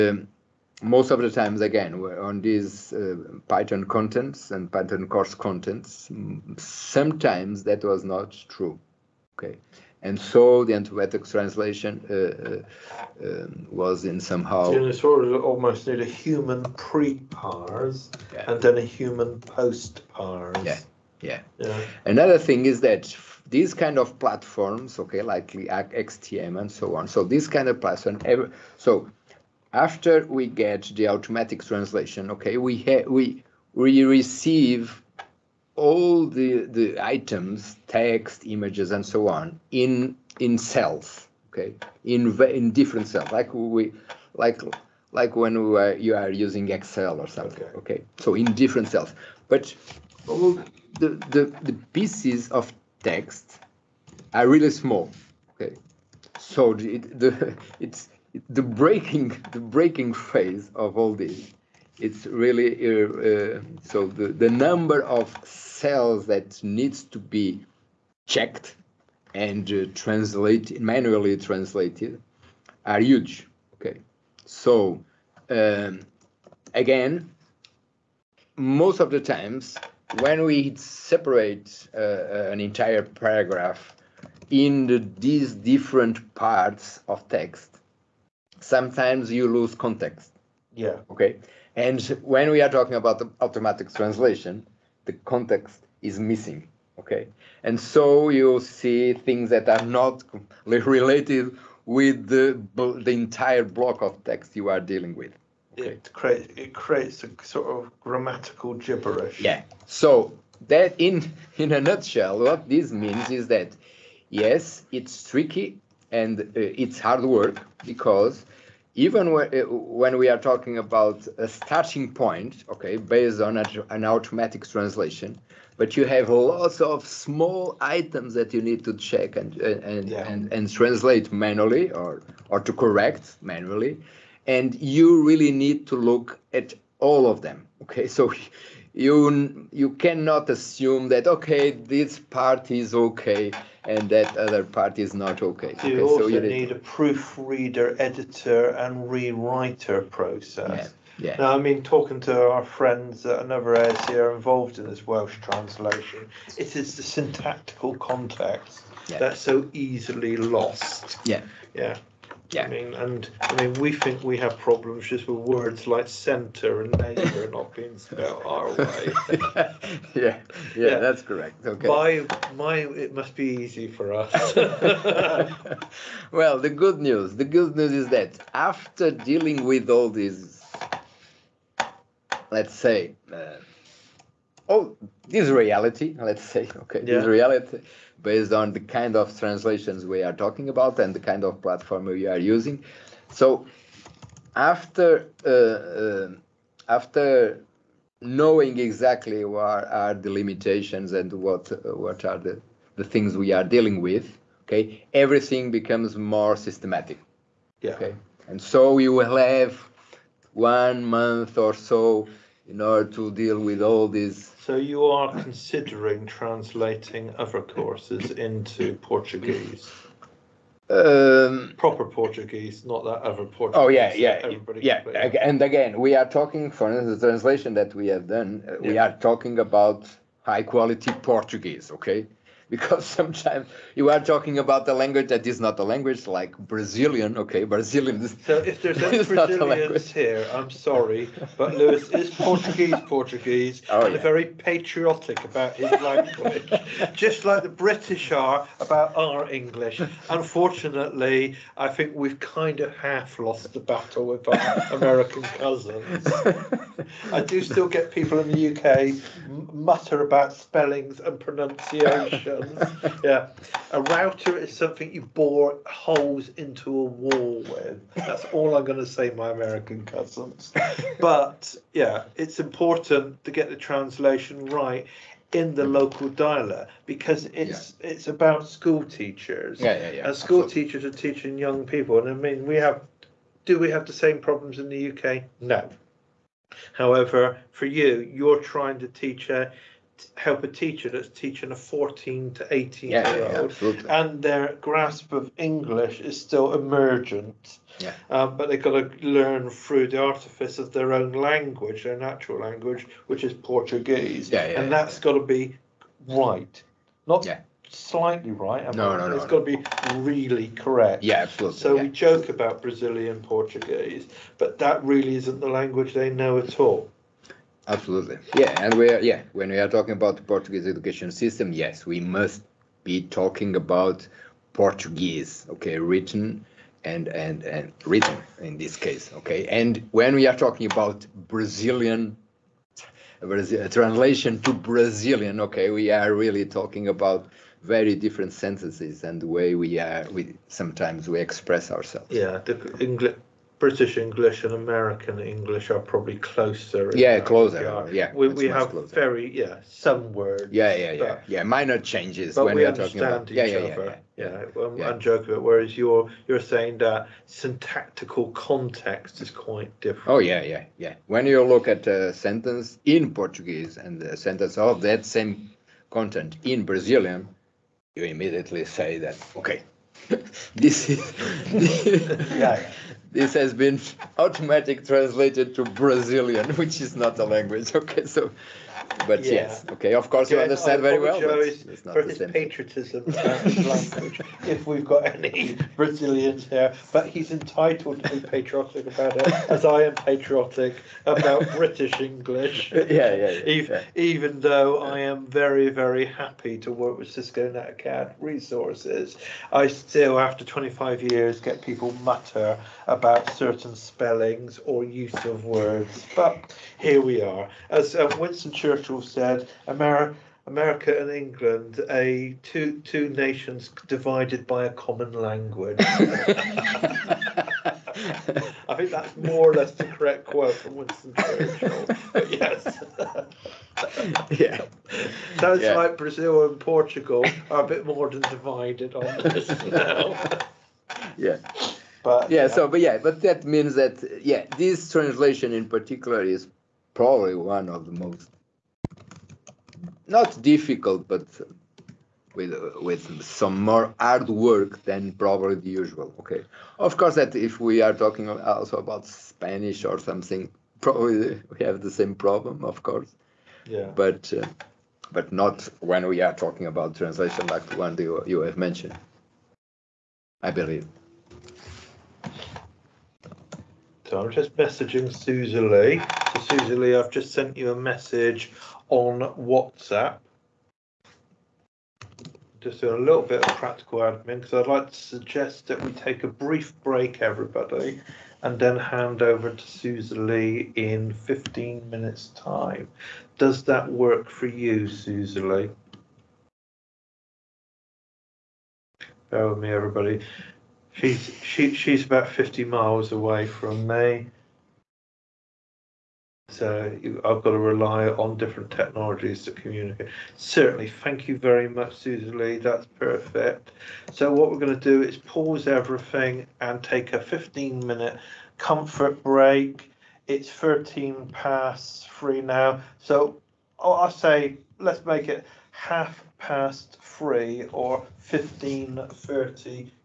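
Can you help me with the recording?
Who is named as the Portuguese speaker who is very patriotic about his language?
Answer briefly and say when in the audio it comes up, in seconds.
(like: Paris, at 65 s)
Lewis, at 241 s.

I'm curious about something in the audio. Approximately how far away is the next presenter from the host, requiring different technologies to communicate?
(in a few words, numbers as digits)
50 miles.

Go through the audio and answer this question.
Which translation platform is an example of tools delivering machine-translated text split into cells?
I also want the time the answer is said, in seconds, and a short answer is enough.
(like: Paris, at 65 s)
XTM, at 25 s.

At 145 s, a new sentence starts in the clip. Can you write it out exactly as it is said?
So you okay, also so you need a proofreader, editor, and rewriter process.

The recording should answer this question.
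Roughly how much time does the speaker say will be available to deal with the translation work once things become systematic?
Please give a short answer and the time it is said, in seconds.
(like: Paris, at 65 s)
one month, at 210 s.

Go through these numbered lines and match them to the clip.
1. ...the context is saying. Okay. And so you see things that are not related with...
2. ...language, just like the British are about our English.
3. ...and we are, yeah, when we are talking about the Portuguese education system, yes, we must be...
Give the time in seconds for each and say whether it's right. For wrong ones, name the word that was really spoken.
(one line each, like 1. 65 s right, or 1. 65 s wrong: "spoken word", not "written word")
1. 95 s wrong: "missing", not "saying"
2. 246 s right
3. 318 s right.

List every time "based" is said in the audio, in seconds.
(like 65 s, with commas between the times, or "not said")
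122 s, 188 s.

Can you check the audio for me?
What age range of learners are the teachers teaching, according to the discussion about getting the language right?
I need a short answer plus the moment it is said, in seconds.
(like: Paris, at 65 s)
14 to 18, at 291 s.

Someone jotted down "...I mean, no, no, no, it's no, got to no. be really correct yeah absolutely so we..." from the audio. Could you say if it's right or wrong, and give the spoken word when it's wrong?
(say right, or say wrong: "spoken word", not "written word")
right.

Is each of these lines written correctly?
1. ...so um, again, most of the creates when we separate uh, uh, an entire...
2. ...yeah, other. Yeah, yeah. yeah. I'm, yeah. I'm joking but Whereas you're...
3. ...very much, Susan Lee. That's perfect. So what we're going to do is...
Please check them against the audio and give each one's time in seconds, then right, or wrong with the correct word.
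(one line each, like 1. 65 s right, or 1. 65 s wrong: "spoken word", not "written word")
1. 74 s wrong: "times", not "creates"
2. 353 s right
3. 501 s right.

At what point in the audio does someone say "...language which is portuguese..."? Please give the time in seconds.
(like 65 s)
302 s.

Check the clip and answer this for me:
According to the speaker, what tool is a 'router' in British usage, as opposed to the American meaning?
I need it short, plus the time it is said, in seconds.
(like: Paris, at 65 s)
something you bore holes into a wall with, at 265 s.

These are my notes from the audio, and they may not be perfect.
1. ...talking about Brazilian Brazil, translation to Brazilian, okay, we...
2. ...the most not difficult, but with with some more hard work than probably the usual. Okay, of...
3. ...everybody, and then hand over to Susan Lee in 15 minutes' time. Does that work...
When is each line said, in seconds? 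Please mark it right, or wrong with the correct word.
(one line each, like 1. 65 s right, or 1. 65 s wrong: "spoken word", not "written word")
1. 330 s right
2. 438 s right
3. 477 s right.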